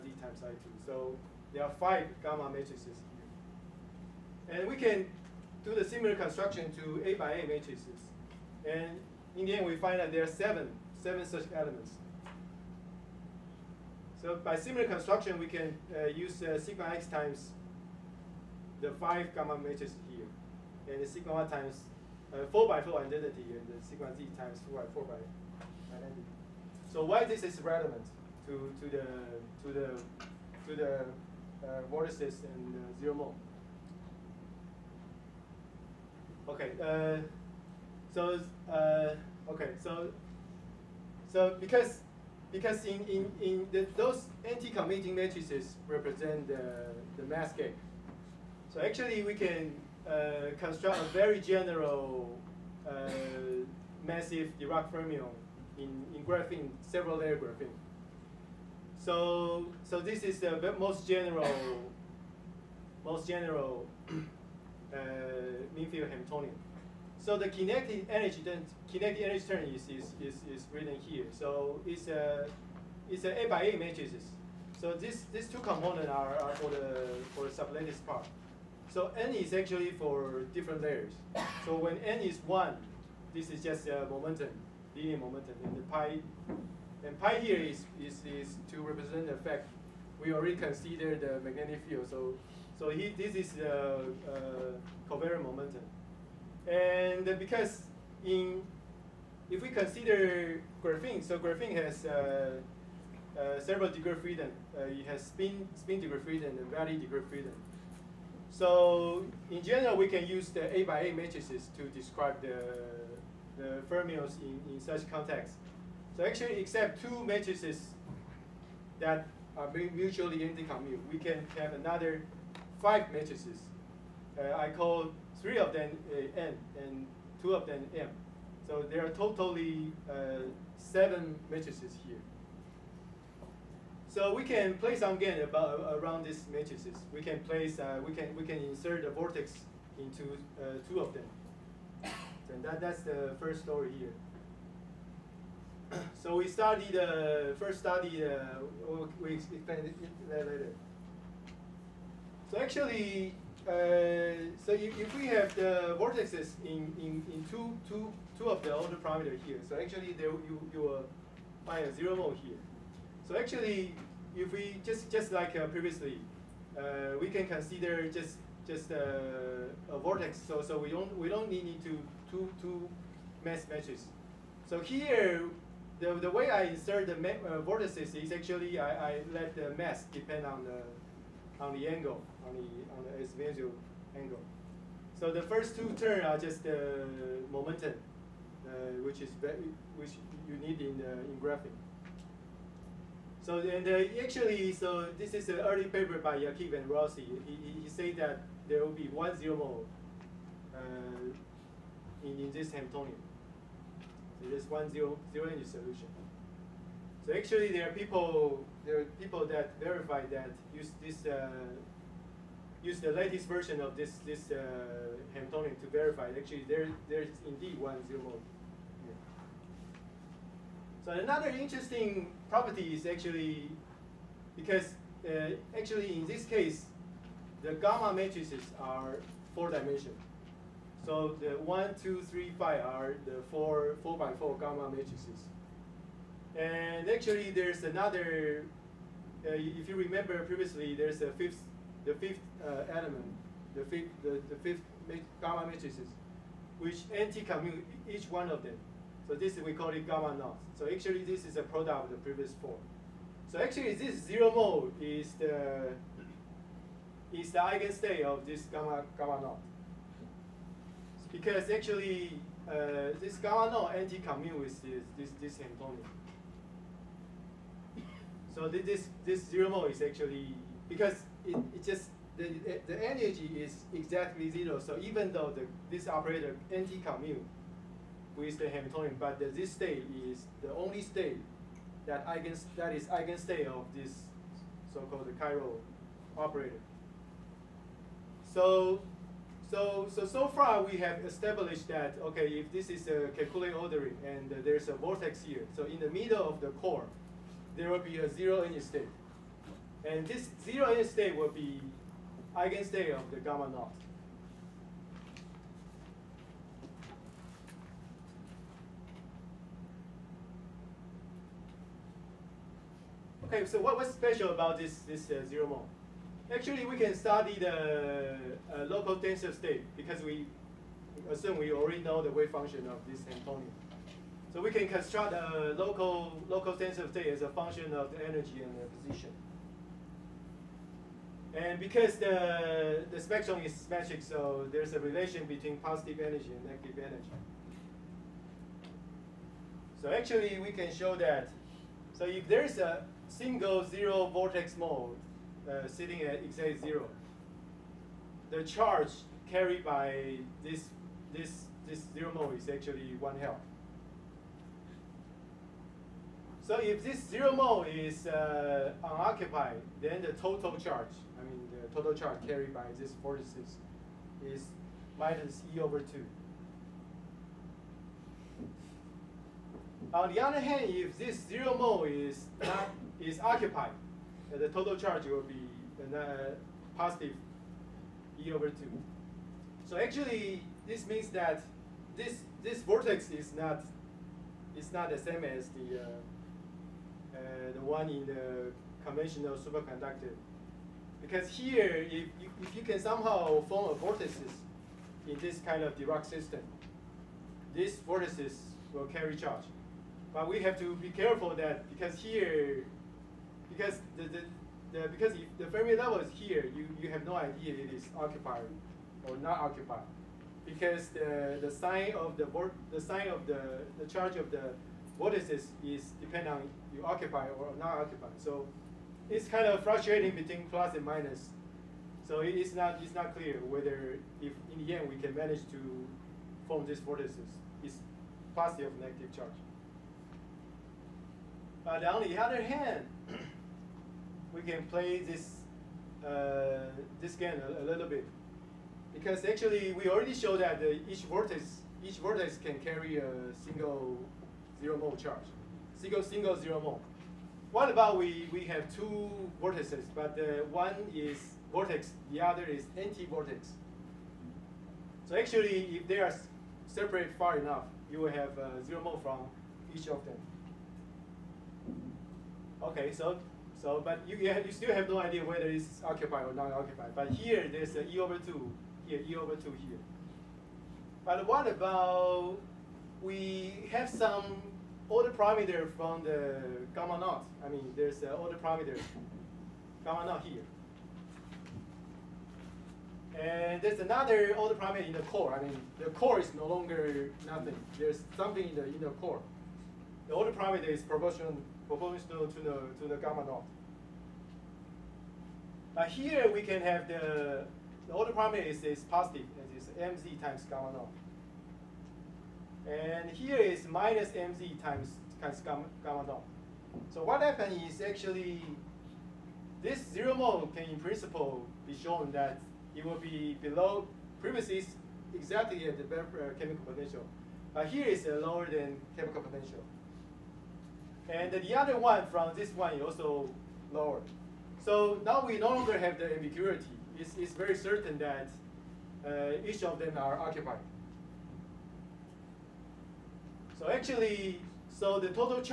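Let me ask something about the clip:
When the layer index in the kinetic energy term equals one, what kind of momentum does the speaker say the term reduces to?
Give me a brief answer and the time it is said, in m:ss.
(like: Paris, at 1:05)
linear momentum, at 1:24.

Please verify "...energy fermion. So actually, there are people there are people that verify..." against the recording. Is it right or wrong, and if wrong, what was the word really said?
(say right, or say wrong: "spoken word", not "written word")
wrong: "solution", not "fermion".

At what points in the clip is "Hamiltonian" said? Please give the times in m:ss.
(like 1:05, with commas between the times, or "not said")
1:06, 3:22, 3:35, 4:25, 4:38, 5:23.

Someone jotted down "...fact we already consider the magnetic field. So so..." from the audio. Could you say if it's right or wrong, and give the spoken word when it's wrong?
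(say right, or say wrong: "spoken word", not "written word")
right.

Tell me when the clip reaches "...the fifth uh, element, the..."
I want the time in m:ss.
4:02.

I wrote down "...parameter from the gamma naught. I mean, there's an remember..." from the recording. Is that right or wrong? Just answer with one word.
wrong.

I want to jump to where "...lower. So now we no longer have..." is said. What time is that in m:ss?
8:43.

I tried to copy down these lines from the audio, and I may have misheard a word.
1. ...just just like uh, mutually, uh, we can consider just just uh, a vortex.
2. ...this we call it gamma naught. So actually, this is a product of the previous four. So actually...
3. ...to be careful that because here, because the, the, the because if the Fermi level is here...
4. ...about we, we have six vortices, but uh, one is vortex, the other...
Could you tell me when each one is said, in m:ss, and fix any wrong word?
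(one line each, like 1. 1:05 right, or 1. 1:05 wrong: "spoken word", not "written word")
1. 2:44 wrong: "previously", not "mutually"
2. 4:09 right
3. 6:40 right
4. 7:27 wrong: "two", not "six".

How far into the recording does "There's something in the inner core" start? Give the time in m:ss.
8:07.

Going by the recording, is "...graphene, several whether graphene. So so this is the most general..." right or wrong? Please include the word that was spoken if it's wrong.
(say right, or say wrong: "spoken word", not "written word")
wrong: "layer", not "whether".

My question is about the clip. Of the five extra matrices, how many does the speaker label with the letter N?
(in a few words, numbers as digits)
3.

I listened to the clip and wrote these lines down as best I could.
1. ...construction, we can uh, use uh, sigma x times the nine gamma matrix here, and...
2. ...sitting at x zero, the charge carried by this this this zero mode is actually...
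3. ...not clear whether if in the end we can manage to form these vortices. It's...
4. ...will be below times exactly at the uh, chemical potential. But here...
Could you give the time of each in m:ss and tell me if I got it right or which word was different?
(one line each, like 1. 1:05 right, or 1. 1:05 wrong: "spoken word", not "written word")
1. 0:14 wrong: "five", not "nine"
2. 5:45 right
3. 7:03 right
4. 8:33 wrong: "premises", not "times".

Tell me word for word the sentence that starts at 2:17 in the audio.
We can place, uh, we can we can insert a vortex into uh, two of them.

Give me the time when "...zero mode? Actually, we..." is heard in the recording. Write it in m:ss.
5:15.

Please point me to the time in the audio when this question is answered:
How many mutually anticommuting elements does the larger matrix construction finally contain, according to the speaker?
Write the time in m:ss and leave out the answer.
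0:10.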